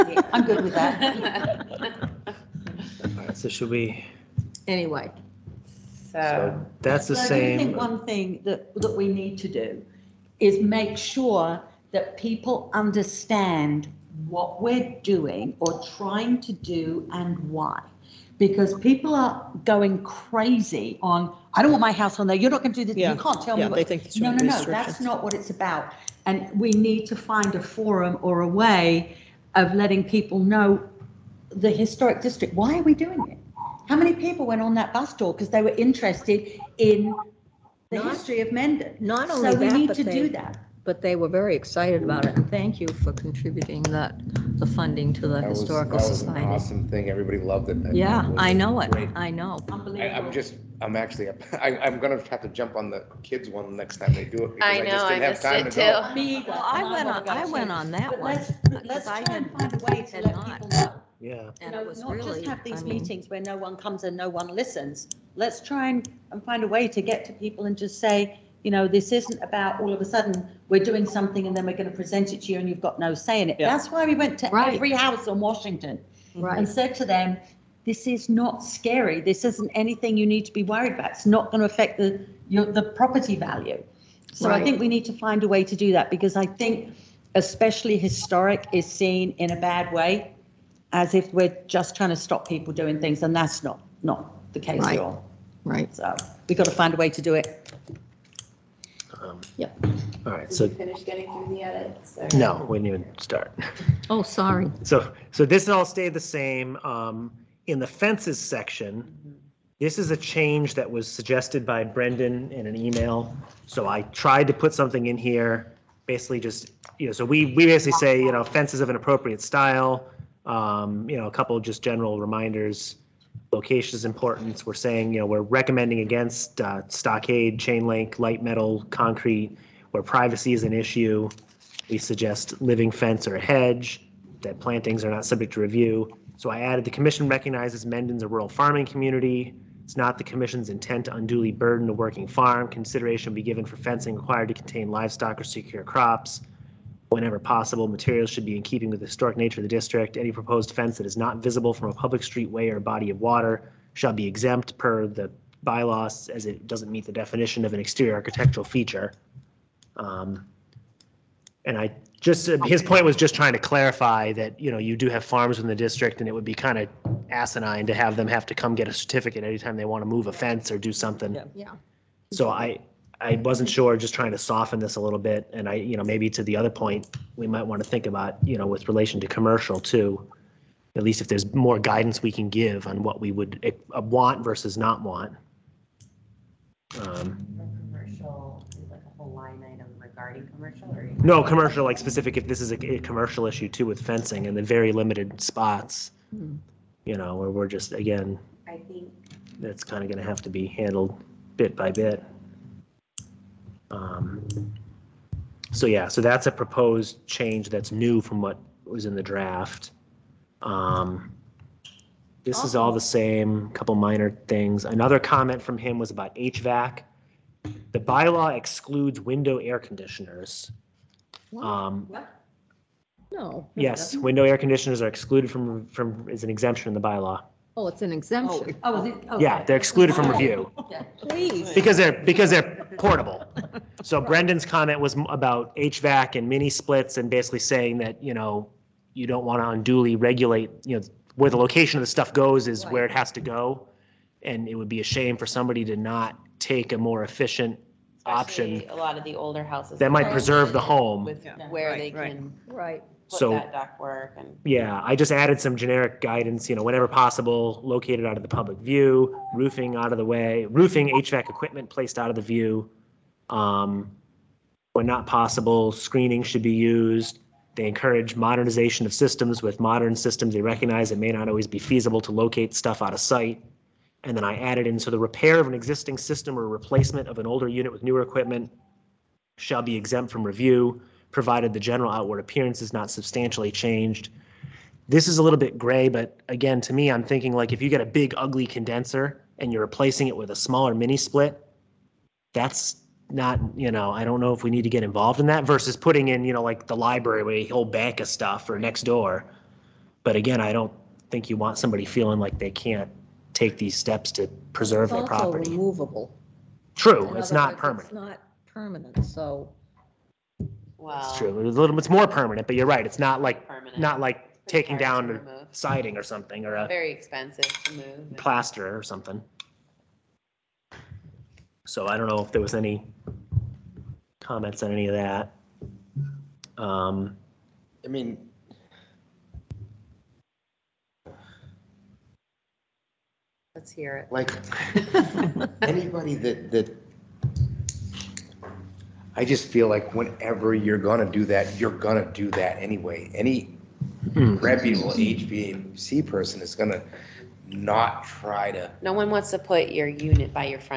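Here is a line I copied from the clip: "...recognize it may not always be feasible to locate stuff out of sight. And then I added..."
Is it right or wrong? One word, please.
right.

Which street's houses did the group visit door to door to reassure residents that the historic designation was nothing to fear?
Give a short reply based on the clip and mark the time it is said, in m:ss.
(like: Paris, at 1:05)
Washington, at 1:15.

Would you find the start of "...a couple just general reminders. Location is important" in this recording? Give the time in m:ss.
2:01.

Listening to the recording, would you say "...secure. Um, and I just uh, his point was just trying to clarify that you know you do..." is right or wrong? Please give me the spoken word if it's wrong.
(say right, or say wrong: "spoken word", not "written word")
wrong: "feature", not "secure".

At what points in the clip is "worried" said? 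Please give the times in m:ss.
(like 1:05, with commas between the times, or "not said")
1:20.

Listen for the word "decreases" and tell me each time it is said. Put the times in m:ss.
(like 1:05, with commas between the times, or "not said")
not said.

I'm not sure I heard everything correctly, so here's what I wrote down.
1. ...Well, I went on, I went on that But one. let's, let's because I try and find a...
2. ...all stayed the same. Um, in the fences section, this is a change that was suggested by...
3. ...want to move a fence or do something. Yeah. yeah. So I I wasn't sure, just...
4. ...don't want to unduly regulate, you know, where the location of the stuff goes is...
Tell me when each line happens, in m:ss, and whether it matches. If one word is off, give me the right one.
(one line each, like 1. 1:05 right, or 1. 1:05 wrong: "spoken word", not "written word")
1. 0:56 right
2. 1:45 right
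3. 2:49 right
4. 3:59 right.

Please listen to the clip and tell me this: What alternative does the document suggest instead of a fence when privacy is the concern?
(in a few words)
living fence or a hedge.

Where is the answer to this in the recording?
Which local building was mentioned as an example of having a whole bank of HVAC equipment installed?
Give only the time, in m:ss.
4:56.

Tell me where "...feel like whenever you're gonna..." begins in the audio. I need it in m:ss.
5:39.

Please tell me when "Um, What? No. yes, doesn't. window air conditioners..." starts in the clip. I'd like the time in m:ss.
3:41.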